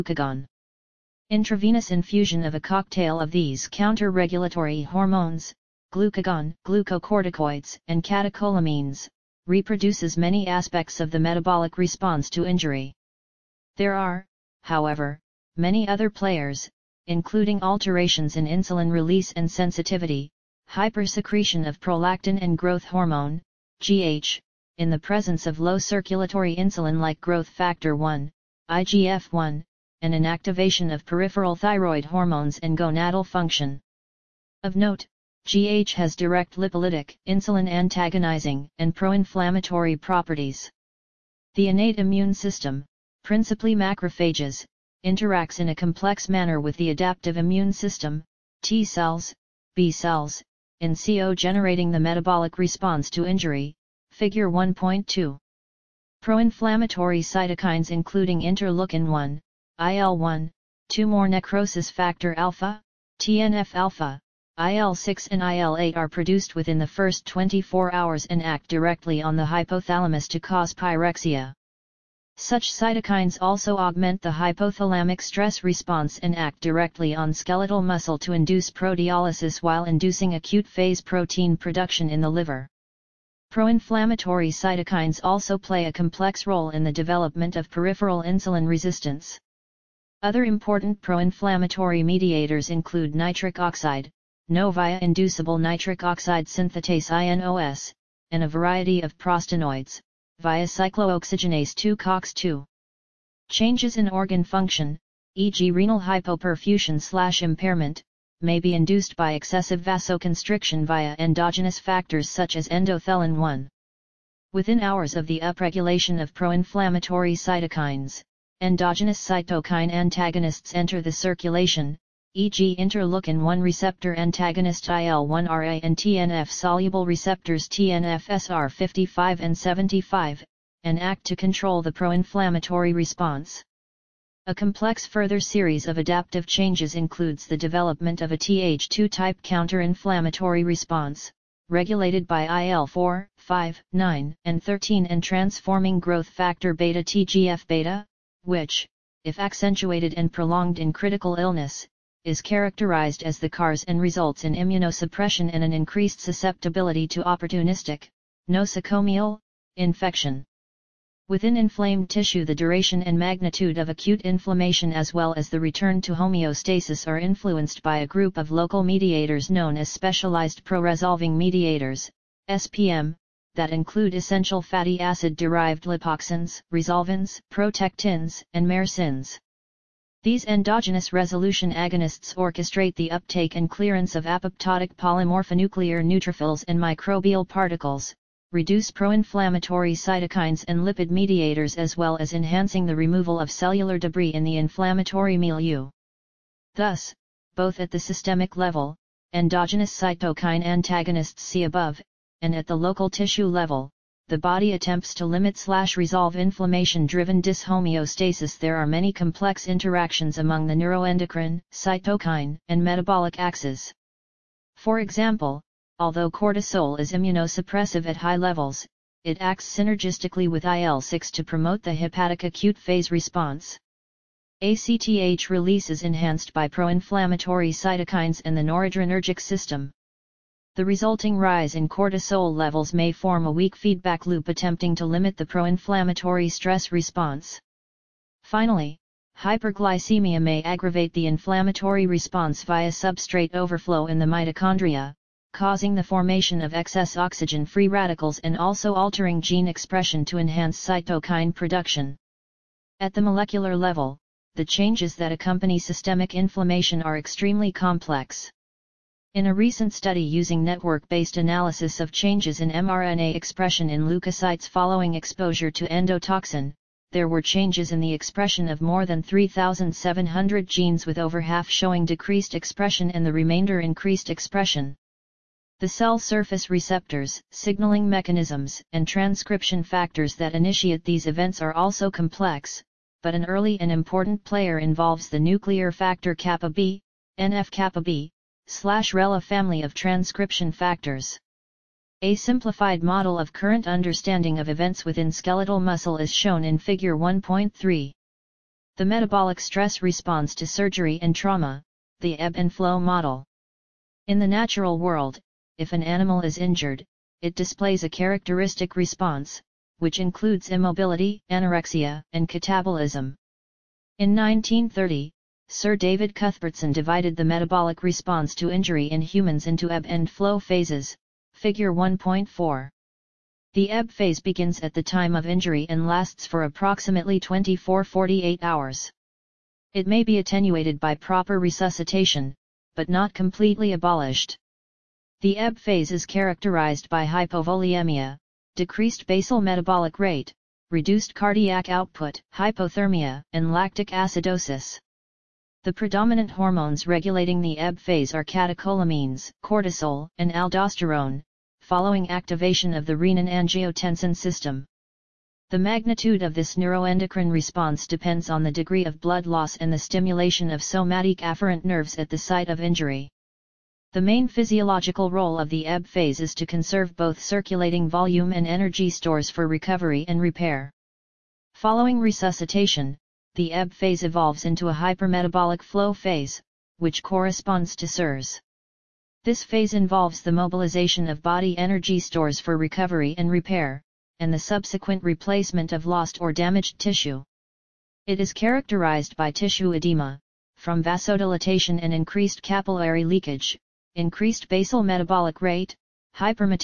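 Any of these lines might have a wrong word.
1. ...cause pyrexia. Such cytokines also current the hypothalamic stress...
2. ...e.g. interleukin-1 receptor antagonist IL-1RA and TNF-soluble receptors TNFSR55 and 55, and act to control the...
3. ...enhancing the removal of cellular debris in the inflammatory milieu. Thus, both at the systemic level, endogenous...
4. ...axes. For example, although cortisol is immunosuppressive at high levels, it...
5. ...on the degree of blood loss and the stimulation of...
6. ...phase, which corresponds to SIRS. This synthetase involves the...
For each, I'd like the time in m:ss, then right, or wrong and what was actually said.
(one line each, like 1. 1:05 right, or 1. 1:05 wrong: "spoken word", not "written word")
1. 1:10 wrong: "augment", not "current"
2. 2:02 wrong: "75", not "55"
3. 3:12 right
4. 3:33 right
5. 5:58 right
6. 6:16 wrong: "phase", not "synthetase".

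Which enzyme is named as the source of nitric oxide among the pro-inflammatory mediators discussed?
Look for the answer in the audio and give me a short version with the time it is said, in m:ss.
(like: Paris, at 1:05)
Inducible nitric oxide synthetase, at 1:35.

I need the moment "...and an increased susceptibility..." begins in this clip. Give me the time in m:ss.
2:35.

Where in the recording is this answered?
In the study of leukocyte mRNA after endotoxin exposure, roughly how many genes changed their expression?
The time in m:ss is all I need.
4:28.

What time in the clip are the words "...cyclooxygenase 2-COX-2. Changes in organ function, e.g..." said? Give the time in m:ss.
1:40.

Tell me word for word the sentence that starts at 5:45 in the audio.
The predominant hormones regulating the ebb phase are catecholamines, cortisol, and aldosterone, following activation of the renin-angiotensin system.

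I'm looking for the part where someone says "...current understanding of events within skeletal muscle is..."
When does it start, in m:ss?
4:53.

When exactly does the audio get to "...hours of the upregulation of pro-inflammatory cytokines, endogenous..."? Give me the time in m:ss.
1:54.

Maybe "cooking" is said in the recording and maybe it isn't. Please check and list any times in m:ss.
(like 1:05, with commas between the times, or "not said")
not said.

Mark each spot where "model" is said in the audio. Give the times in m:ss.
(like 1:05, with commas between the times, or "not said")
4:53, 5:03.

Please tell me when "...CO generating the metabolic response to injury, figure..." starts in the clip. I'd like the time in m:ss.
0:50.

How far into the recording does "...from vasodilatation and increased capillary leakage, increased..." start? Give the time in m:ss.
6:30.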